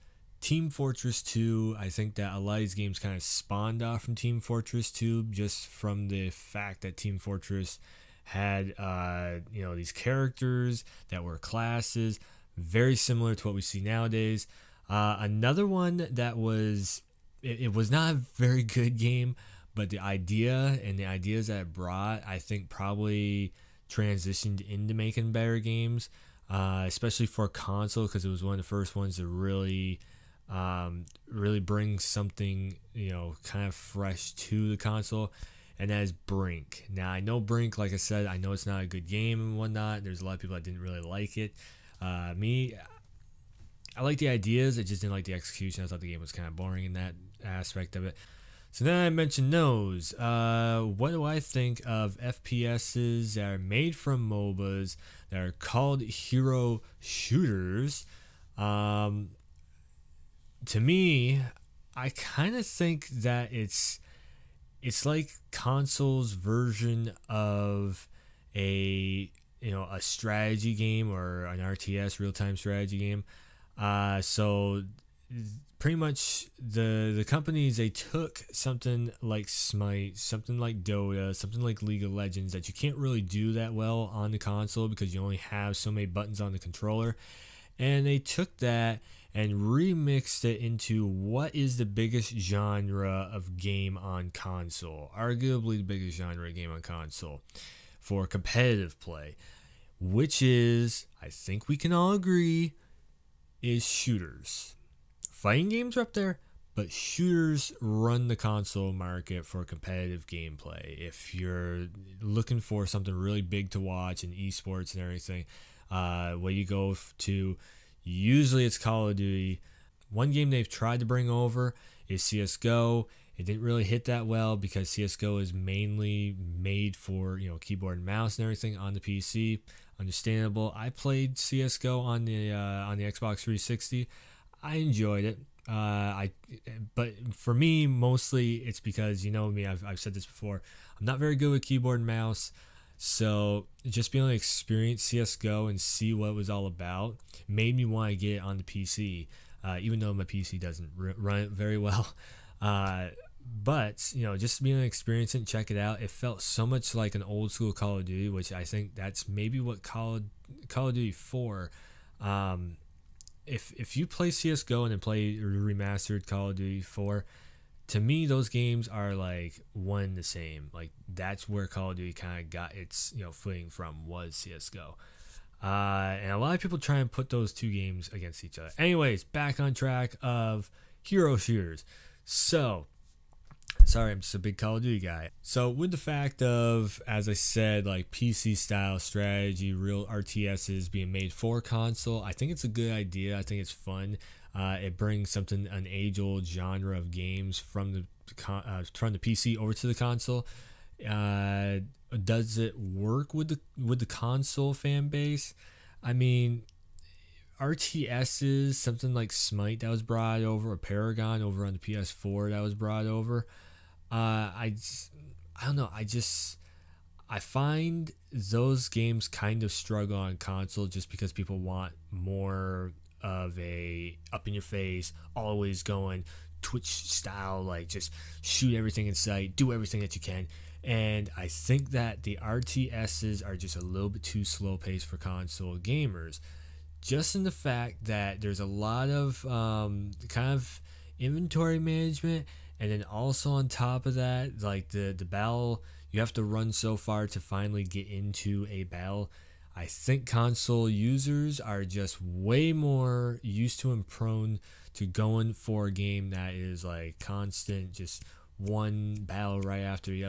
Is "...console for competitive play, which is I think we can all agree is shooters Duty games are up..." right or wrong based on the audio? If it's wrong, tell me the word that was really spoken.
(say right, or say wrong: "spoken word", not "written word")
wrong: "Fighting", not "Duty".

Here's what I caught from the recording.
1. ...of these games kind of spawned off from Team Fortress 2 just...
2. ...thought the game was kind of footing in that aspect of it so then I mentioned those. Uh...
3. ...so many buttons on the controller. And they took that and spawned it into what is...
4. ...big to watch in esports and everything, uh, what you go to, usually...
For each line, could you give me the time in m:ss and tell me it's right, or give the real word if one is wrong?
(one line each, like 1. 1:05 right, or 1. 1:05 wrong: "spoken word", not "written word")
1. 0:02 right
2. 0:45 wrong: "boring", not "footing"
3. 1:25 wrong: "remixed", not "spawned"
4. 1:53 right.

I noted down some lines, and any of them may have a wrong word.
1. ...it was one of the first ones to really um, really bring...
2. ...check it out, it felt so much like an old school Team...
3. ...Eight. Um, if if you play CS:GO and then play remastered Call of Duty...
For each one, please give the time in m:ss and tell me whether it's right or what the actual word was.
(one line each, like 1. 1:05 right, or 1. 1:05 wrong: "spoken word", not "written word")
1. 0:28 right
2. 2:35 wrong: "Call", not "Team"
3. 2:41 wrong: "Four", not "Eight".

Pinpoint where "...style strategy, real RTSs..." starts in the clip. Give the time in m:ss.
3:08.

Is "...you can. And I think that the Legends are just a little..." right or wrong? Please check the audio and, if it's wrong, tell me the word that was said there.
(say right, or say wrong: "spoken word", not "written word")
wrong: "RTSs", not "Legends".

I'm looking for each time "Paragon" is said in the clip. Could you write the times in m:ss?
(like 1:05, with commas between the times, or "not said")
3:30.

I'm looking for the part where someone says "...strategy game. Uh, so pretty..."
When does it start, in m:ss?
1:12.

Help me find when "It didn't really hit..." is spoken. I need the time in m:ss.
2:03.